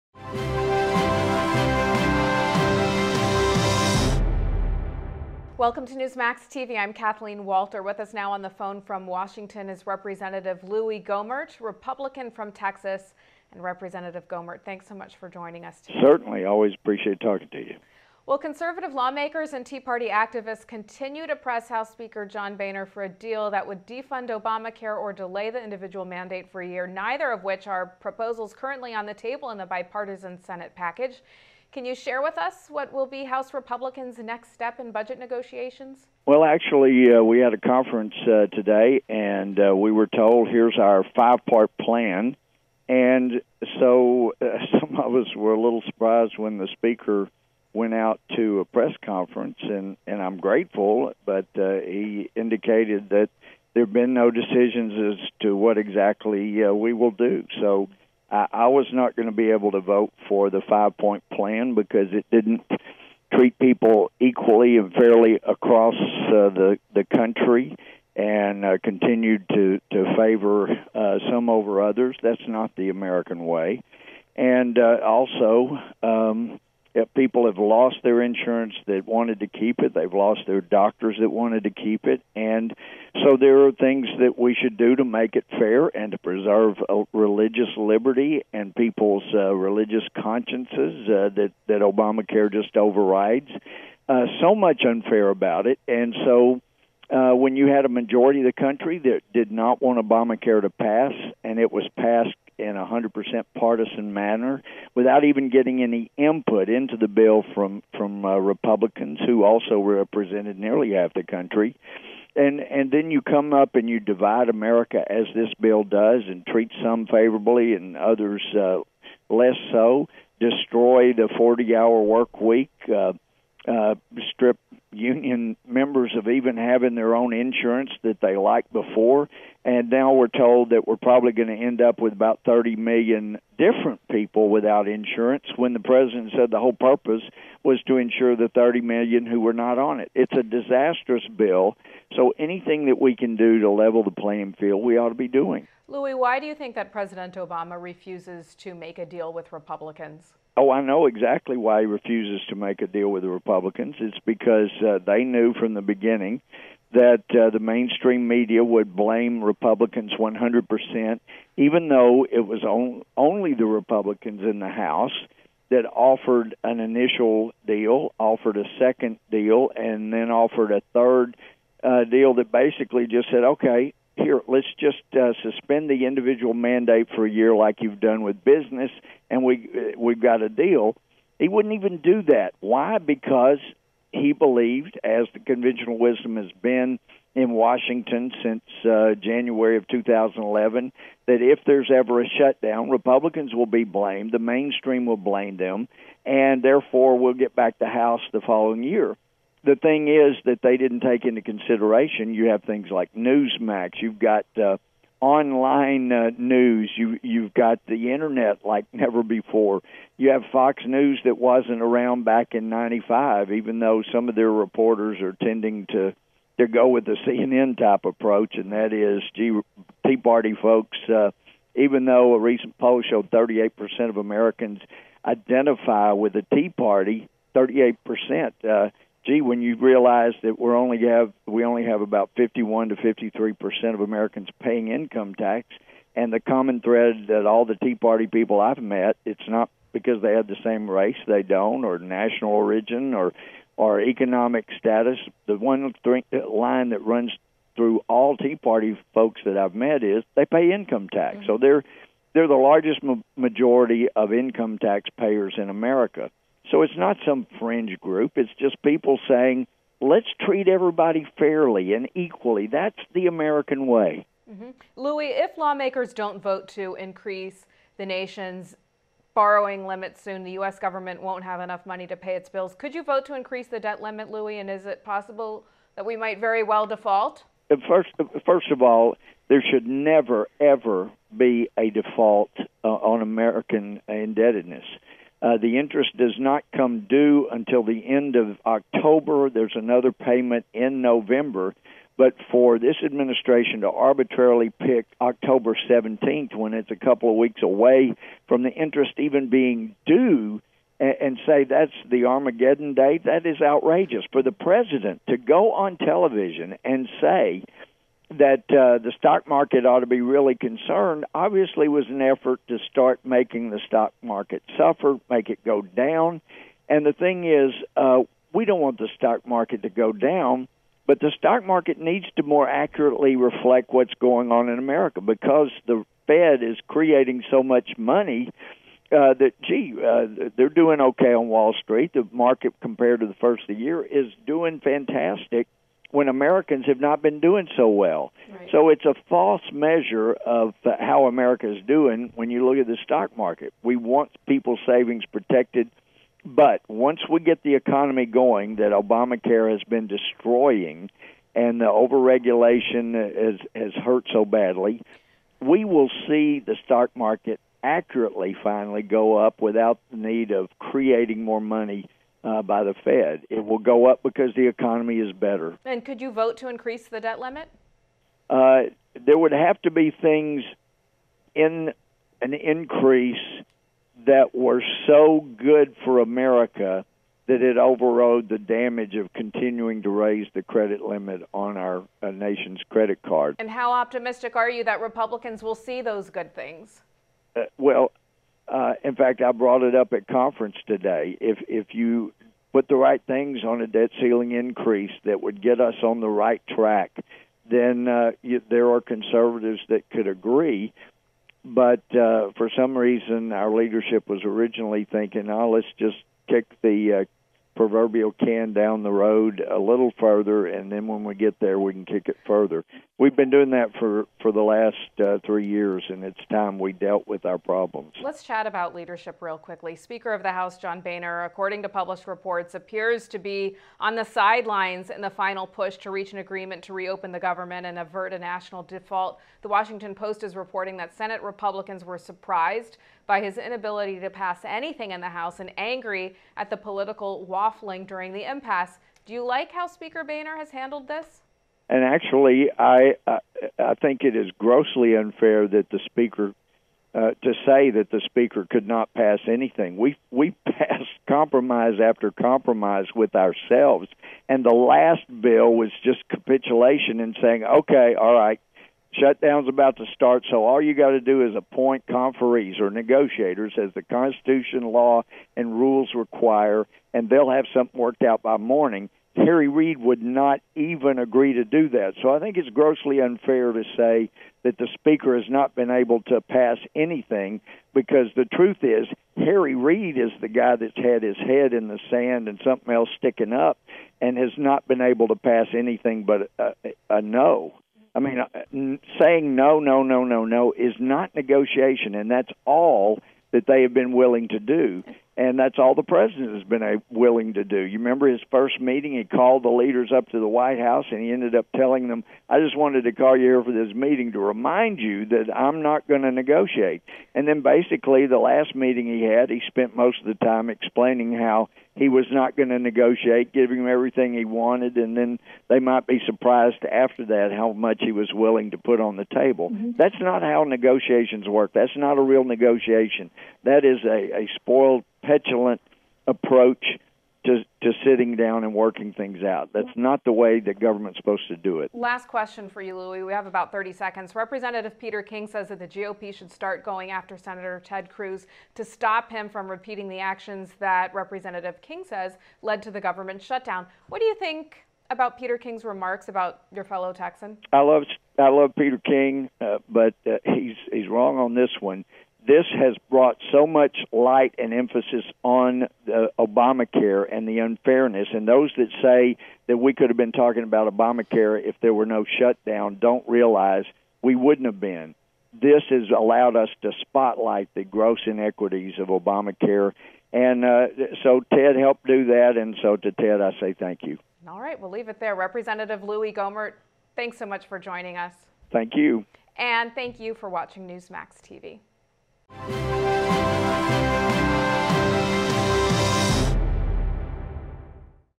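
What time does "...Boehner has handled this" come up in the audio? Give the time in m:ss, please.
7:20.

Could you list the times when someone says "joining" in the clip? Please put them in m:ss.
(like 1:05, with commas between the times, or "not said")
0:15, 9:37.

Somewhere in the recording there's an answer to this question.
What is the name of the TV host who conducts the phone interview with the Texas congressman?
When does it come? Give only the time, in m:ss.
0:06.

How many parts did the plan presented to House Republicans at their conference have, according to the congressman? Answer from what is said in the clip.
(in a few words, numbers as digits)
5.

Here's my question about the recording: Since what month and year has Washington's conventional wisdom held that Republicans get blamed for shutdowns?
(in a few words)
January 2011.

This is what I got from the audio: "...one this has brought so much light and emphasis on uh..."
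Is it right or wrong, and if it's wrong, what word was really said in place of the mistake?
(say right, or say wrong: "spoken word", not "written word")
right.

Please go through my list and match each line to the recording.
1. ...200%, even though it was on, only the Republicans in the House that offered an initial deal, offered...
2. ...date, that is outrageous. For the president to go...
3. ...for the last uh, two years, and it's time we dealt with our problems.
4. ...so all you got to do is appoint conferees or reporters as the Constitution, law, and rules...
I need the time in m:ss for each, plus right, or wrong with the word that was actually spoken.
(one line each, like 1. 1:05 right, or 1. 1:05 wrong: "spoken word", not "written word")
1. 2:40 wrong: "100", not "200"
2. 5:02 right
3. 6:54 wrong: "three", not "two"
4. 7:40 wrong: "negotiators", not "reporters".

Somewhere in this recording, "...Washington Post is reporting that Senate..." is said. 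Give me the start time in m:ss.
7:09.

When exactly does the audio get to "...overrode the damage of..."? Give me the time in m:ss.
6:17.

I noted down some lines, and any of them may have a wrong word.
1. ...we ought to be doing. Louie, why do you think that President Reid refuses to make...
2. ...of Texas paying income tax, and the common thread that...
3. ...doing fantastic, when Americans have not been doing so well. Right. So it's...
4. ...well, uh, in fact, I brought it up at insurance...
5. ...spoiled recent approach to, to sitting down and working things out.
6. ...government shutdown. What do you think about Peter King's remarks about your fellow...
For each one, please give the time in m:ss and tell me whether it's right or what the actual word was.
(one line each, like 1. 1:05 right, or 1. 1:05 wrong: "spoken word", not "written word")
1. 2:24 wrong: "Obama", not "Reid"
2. 3:53 wrong: "Americans", not "Texas"
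3. 5:34 right
4. 6:27 wrong: "conference", not "insurance"
5. 8:44 wrong: "petulant", not "recent"
6. 9:03 right.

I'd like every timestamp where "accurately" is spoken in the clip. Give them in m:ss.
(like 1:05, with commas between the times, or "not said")
5:22, 5:57.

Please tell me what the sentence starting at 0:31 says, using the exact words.
Can you share with us what will be House Republicans' next step in budget negotiations?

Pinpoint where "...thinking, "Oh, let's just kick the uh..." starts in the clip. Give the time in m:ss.
6:45.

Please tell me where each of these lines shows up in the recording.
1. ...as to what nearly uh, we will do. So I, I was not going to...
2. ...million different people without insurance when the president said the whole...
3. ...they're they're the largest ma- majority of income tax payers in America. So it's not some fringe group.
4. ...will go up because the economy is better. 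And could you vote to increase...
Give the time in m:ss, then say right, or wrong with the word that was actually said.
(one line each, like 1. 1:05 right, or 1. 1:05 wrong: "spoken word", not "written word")
1. 0:55 wrong: "exactly", not "nearly"
2. 2:12 right
3. 4:11 right
4. 6:03 right.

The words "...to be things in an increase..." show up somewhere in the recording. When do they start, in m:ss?
6:09.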